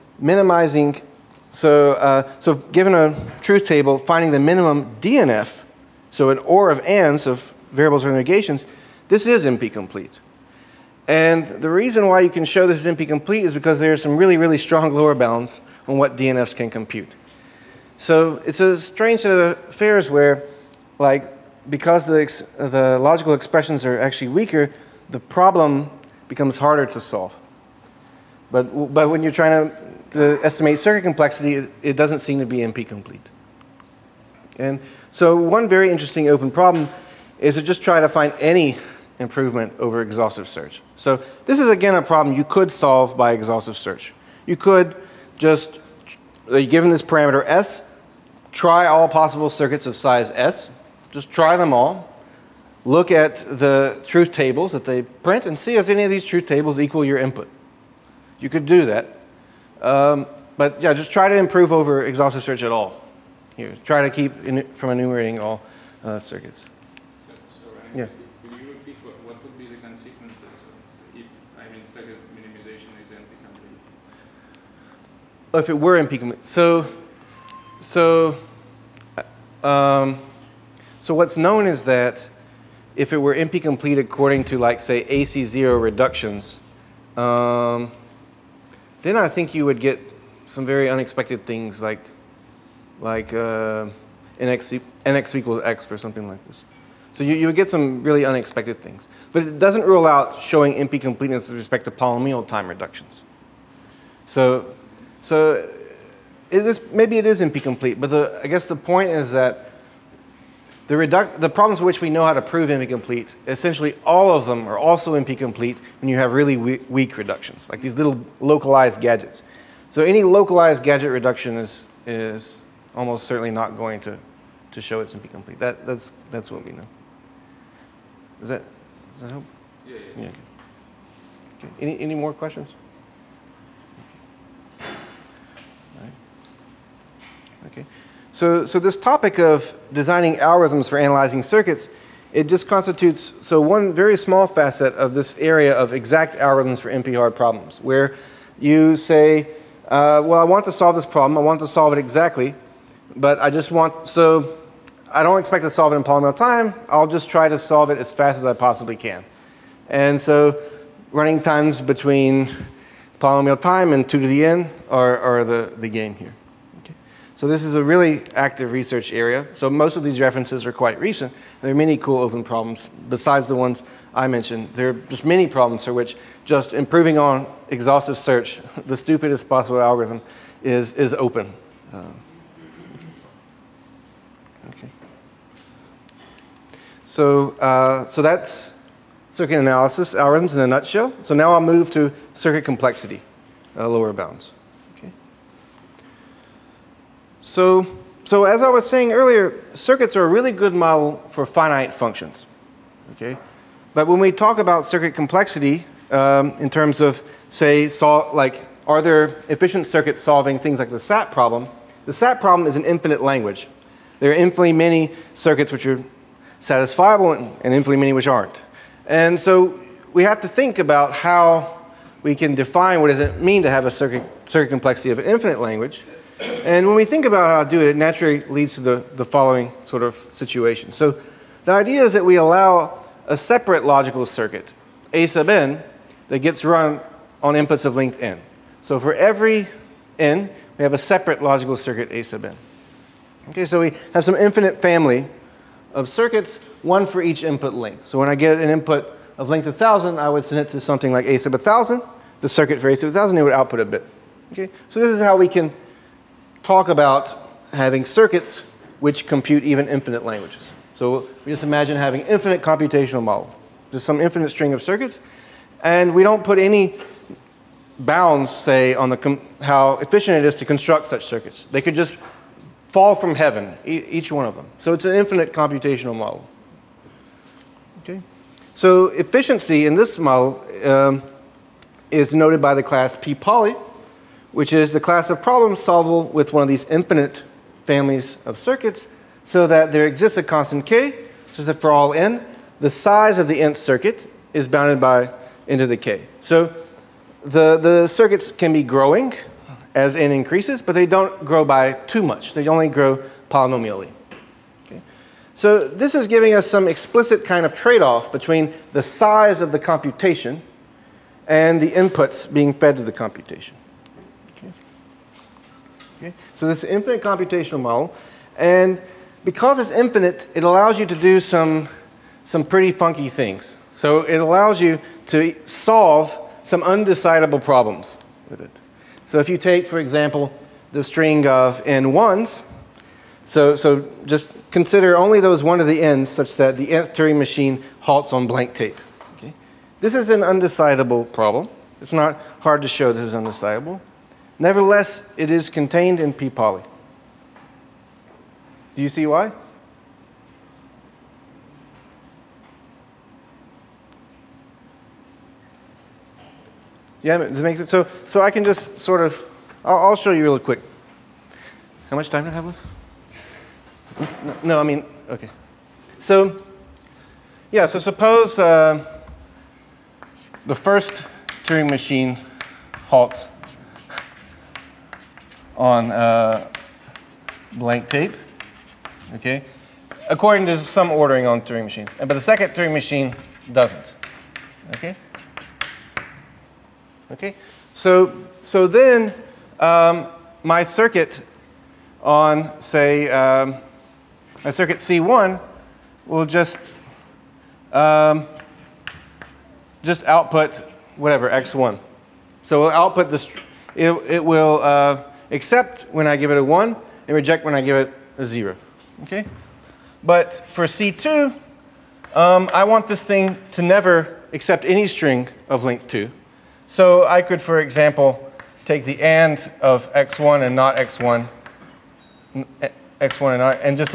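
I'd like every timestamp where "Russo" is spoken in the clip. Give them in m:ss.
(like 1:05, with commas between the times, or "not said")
not said.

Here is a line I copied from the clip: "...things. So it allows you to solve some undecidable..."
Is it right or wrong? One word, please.
right.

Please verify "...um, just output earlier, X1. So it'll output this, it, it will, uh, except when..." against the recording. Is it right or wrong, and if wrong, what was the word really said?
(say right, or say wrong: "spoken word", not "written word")
wrong: "whatever", not "earlier".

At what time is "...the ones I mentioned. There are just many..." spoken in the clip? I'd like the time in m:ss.
2:53.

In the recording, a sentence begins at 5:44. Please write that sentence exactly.
Nevertheless, it is contained in P poly.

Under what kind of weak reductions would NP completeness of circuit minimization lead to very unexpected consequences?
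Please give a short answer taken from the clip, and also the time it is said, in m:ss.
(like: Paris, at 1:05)
AC0 reductions, at 1:25.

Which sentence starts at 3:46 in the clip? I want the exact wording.
And when we think about how to do it, it naturally leads to the, the following sort of situation.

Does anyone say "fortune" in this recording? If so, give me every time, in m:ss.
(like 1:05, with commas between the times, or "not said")
not said.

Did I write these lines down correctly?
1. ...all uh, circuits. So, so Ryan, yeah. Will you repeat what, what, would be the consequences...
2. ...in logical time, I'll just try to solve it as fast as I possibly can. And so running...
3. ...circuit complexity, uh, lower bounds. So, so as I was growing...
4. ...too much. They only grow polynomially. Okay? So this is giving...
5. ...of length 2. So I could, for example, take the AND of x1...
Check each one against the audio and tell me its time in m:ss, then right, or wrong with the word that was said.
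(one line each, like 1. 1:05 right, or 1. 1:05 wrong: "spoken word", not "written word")
1. 1:05 right
2. 2:35 wrong: "polynomial", not "logical"
3. 3:12 wrong: "saying", not "growing"
4. 5:01 right
5. 6:55 right.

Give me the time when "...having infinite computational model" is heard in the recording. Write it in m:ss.
4:21.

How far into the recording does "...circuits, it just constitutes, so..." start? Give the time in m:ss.
2:21.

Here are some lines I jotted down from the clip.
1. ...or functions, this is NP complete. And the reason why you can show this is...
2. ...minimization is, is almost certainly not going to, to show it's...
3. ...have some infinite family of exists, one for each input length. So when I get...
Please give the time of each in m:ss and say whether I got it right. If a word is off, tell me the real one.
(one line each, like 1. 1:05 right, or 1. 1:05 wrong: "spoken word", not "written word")
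1. 0:08 wrong: "negations", not "functions"
2. 2:01 wrong: "reduction", not "minimization"
3. 4:04 wrong: "circuits", not "exists".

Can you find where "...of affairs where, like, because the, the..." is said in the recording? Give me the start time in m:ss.
0:19.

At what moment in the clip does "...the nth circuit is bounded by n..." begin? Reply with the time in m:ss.
4:53.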